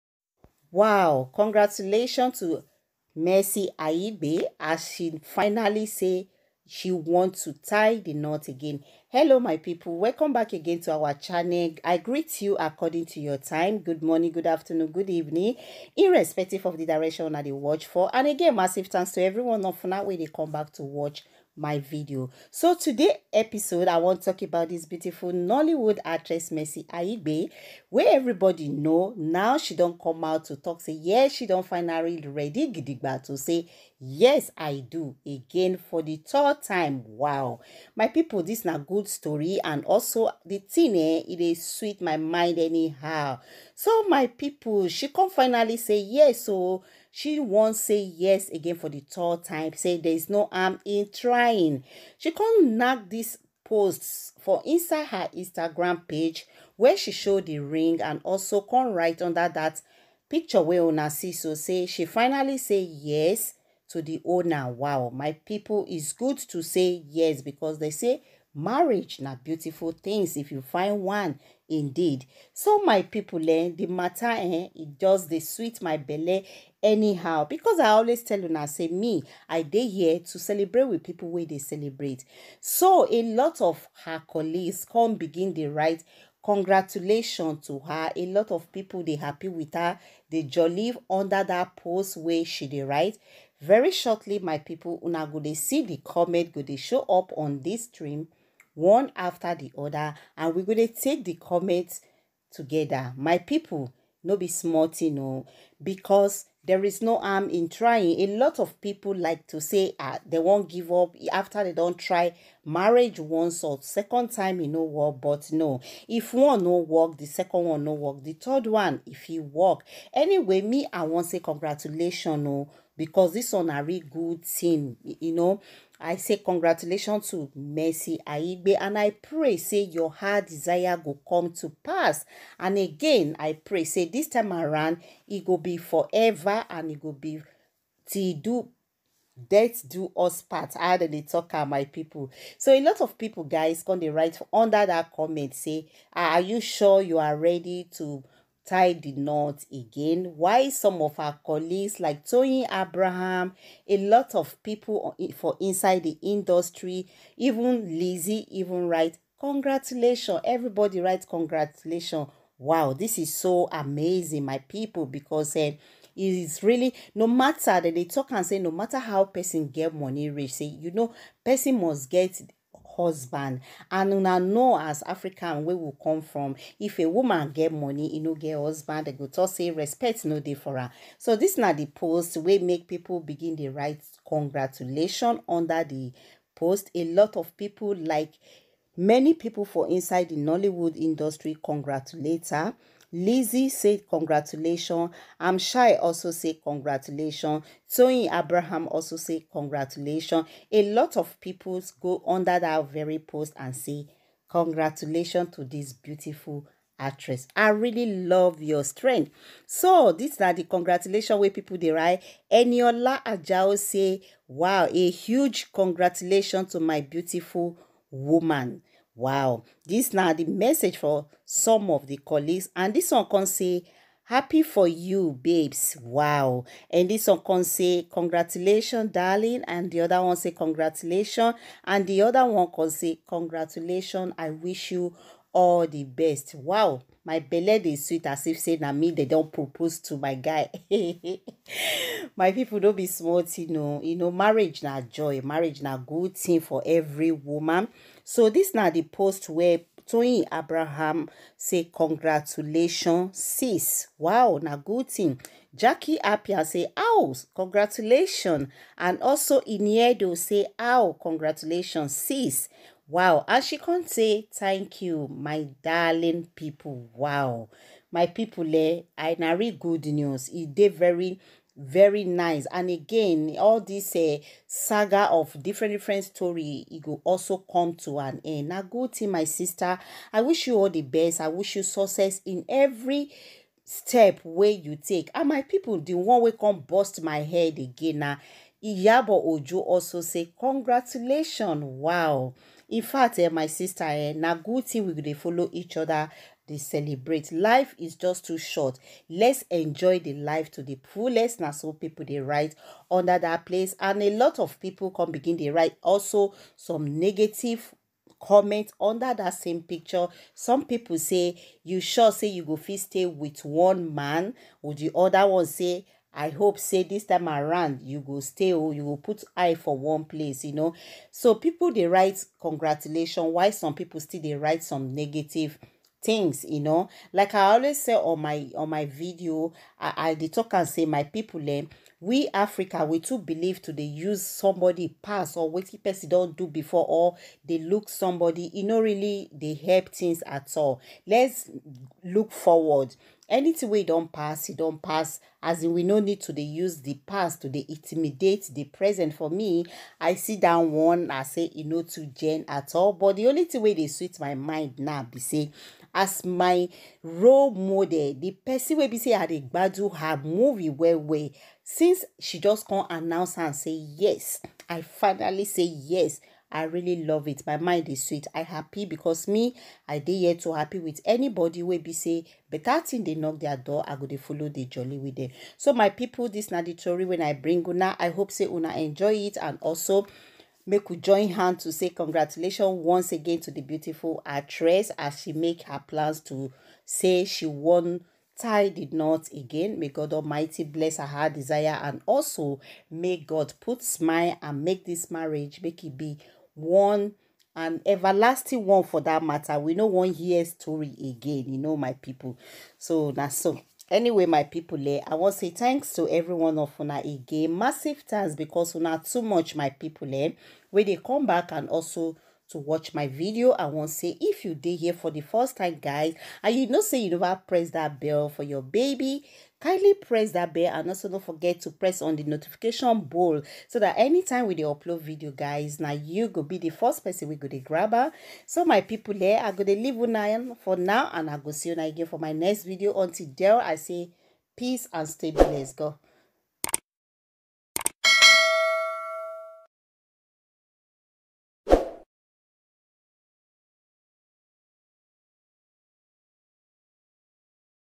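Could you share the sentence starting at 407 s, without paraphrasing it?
Massive thanks because not too much, my people.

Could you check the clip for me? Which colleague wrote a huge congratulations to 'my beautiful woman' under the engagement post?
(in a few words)
Eniola Ajao.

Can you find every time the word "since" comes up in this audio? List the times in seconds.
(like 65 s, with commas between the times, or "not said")
361 s.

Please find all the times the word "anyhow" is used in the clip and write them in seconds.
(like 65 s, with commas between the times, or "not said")
42 s, 76 s.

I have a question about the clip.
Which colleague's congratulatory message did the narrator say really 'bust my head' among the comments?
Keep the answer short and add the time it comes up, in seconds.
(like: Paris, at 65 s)
Iyabo Ojo, at 288 s.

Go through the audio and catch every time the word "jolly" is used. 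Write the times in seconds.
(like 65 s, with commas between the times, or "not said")
90 s, 374 s.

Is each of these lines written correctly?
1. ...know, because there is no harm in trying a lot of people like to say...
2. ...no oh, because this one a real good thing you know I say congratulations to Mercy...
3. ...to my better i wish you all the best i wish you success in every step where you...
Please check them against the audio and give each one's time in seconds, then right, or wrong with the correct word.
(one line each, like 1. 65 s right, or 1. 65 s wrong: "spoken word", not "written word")
1. 105 s right
2. 122 s right
3. 279 s wrong: "sister", not "better".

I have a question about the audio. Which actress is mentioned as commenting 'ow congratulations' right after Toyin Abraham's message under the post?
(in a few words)
Jackie Appiah.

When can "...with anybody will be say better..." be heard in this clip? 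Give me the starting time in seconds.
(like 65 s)
370 s.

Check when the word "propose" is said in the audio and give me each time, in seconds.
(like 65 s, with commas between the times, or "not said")
239 s.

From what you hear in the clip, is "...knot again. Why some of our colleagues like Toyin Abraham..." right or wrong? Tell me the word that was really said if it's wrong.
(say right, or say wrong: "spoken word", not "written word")
right.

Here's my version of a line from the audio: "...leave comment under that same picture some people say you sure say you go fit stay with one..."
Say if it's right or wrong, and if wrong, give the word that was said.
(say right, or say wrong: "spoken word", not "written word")
wrong: "negative", not "leave".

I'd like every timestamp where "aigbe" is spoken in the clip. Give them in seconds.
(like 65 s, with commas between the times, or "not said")
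3 s, 26 s, 128 s.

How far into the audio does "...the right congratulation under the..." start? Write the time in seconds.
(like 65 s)
183 s.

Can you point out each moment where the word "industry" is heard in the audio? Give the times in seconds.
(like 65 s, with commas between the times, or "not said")
156 s, 190 s.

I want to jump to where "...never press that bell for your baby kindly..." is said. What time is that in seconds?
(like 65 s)
417 s.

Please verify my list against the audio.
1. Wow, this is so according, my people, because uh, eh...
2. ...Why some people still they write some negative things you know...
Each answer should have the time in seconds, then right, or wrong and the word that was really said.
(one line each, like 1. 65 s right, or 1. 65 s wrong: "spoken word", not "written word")
1. 162 s wrong: "amazing", not "according"
2. 323 s right.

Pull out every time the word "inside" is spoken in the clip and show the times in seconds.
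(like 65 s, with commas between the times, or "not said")
54 s, 155 s, 189 s.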